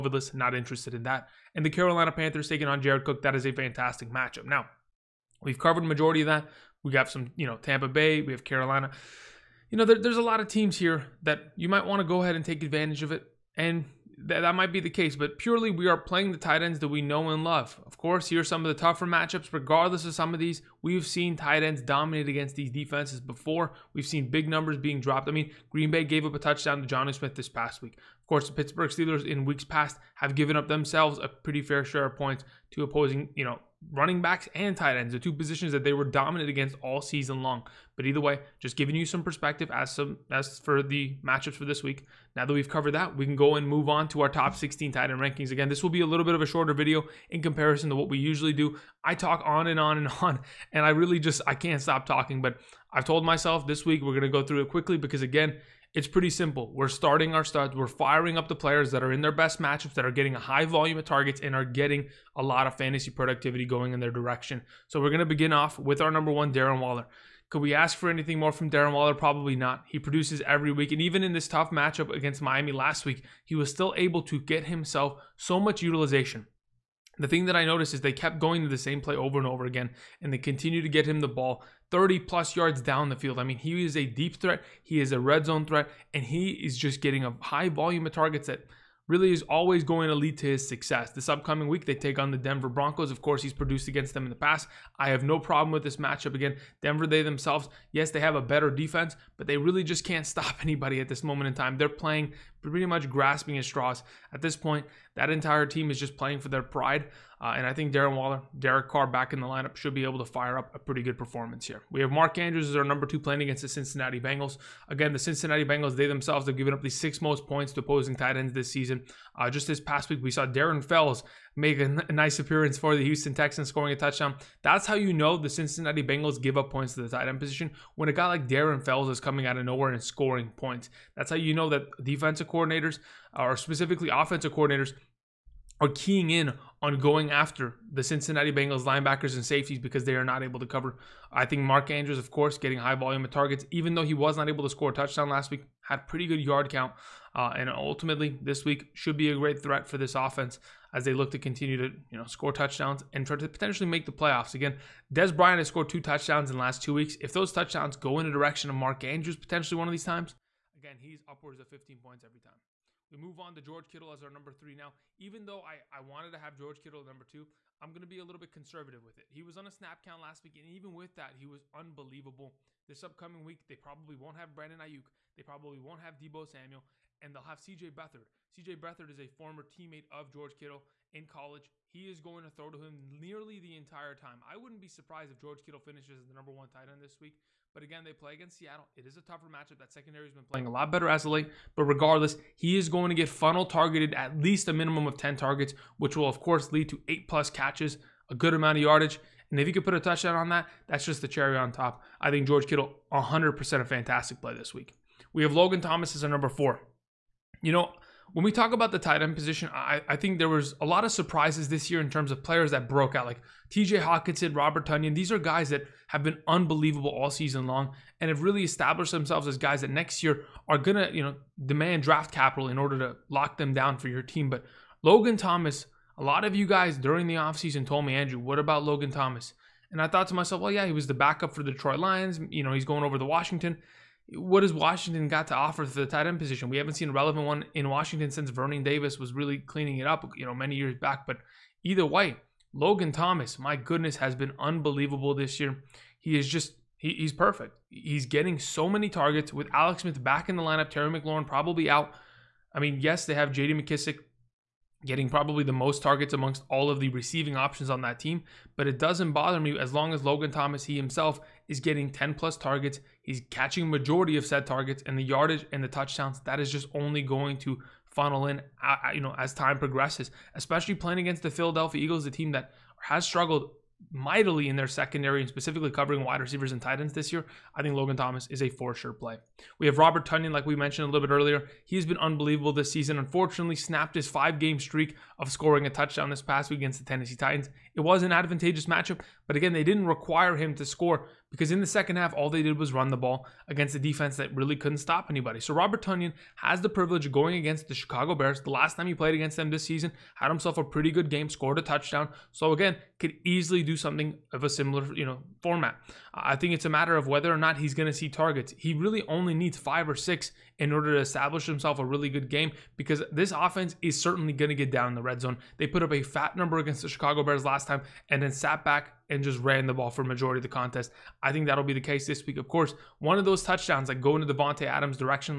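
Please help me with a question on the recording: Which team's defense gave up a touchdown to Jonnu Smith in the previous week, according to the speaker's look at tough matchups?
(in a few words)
Green Bay.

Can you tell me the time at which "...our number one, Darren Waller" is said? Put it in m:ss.
1:06.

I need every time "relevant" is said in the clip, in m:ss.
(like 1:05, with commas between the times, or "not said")
3:57.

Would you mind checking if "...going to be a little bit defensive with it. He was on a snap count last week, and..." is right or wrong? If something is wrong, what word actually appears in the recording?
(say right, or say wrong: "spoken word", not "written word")
wrong: "conservative", not "defensive".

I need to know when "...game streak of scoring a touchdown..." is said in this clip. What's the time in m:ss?
4:44.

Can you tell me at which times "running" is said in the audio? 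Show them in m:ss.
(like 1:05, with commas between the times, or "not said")
0:33.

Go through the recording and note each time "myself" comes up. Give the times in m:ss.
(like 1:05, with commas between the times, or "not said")
0:53, 3:50.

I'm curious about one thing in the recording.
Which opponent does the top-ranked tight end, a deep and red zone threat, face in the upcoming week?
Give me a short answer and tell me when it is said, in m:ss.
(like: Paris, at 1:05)
Denver Broncos, at 1:32.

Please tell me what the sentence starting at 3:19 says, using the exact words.
And if you could put a touchdown on that, that's just the cherry on top.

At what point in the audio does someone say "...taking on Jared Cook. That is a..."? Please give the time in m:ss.
0:02.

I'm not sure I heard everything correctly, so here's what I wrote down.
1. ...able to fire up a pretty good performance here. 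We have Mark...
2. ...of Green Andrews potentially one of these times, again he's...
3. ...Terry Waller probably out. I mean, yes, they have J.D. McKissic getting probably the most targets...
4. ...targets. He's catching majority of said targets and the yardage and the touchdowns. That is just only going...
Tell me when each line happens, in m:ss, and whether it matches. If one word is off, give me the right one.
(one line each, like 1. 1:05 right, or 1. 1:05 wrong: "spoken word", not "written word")
1. 1:50 right
2. 2:38 wrong: "Mark", not "Green"
3. 4:10 wrong: "McLaurin", not "Waller"
4. 4:22 right.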